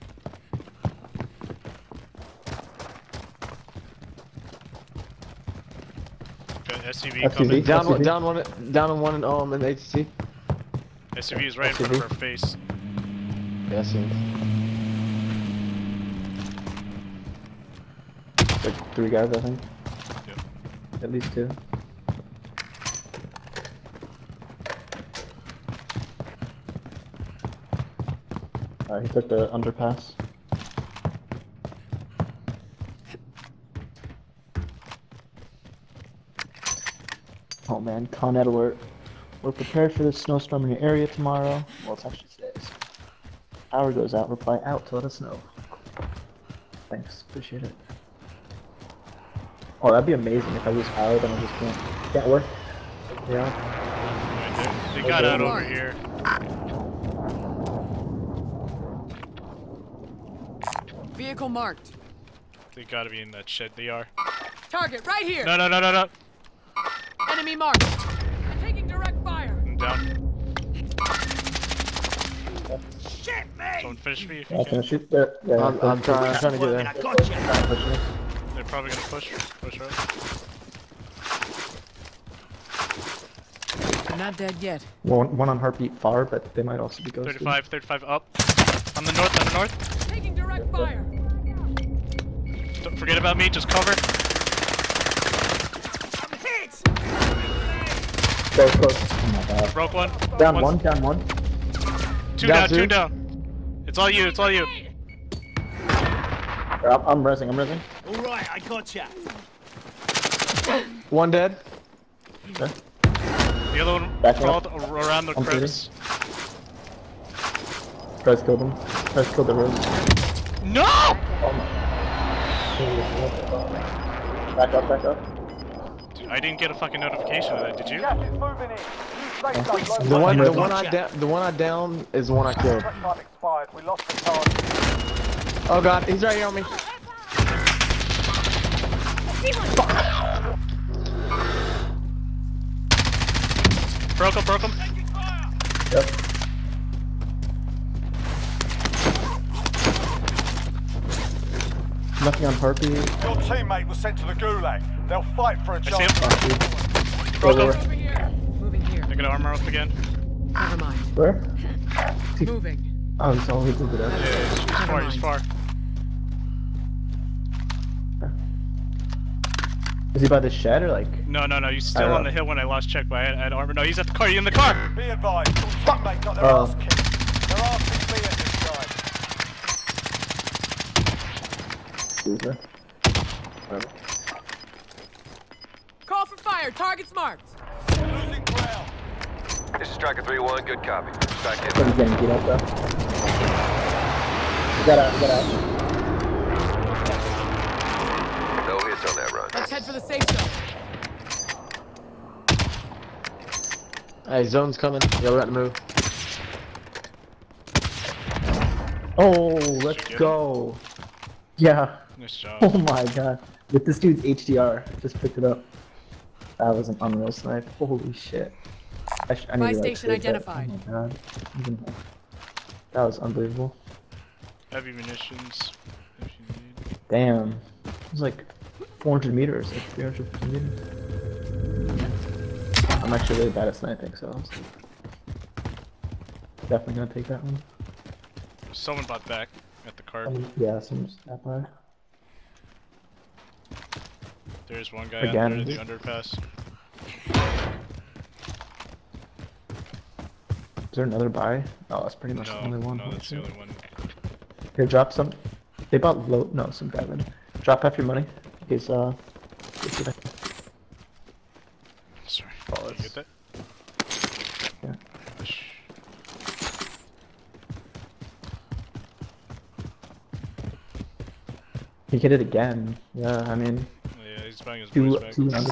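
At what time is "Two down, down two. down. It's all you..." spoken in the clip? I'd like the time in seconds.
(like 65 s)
102 s.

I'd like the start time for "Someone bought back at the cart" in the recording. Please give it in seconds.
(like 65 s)
238 s.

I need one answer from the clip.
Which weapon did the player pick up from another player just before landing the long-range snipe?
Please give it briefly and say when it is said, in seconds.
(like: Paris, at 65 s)
HDR, at 214 s.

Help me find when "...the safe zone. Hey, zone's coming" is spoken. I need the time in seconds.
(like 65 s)
199 s.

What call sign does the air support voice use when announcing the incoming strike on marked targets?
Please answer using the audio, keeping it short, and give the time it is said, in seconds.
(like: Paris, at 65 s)
Striker 3-1, at 189 s.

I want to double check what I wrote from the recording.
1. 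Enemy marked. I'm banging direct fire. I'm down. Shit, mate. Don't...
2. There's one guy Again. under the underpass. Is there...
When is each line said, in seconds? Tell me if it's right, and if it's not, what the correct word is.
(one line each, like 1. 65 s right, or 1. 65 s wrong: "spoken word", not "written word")
1. 67 s wrong: "taking", not "banging"
2. 244 s right.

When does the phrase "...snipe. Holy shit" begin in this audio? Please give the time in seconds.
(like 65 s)
217 s.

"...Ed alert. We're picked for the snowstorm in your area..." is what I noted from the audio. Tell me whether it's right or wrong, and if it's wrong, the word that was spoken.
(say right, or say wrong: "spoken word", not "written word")
wrong: "prepared", not "picked".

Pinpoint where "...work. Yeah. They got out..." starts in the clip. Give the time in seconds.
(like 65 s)
52 s.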